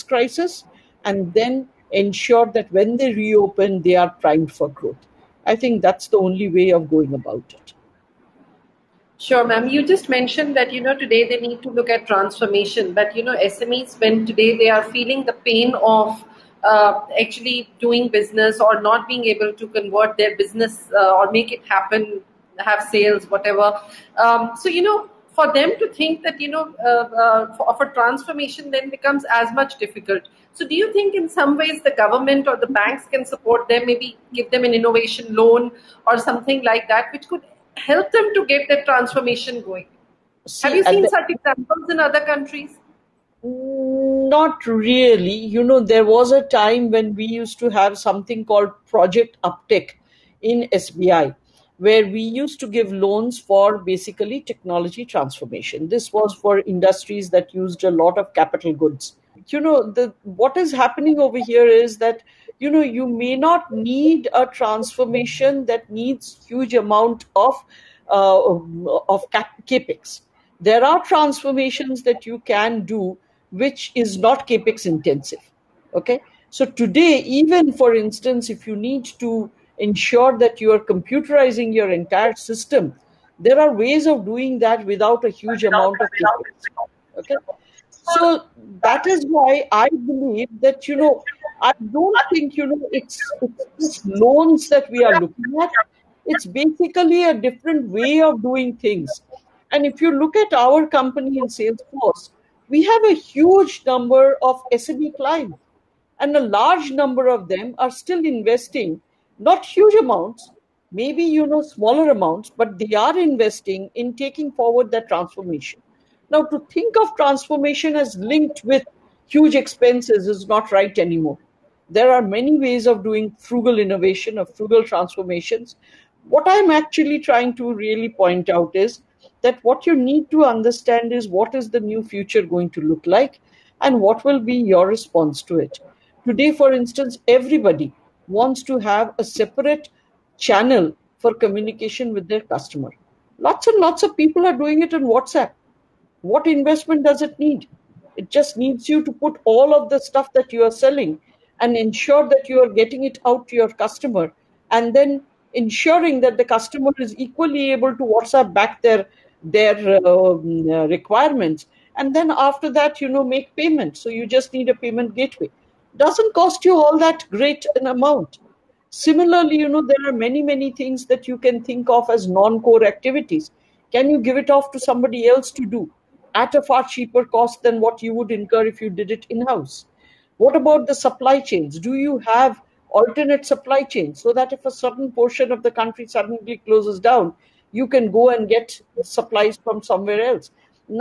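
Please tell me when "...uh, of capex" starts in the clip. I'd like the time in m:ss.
1:08.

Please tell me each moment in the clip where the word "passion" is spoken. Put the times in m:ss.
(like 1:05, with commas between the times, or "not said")
not said.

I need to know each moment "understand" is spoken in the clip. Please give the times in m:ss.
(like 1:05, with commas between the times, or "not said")
2:10.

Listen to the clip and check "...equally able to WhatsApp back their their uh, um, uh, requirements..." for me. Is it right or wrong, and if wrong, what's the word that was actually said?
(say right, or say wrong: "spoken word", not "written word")
right.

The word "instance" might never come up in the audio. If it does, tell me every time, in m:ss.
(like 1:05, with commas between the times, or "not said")
1:17, 2:16.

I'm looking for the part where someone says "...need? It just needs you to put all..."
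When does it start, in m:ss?
2:27.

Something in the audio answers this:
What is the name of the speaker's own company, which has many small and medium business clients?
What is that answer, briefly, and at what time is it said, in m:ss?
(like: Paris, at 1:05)
Salesforce, at 1:41.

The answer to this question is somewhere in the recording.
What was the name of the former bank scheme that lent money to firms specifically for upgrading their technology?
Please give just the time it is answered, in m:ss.
0:48.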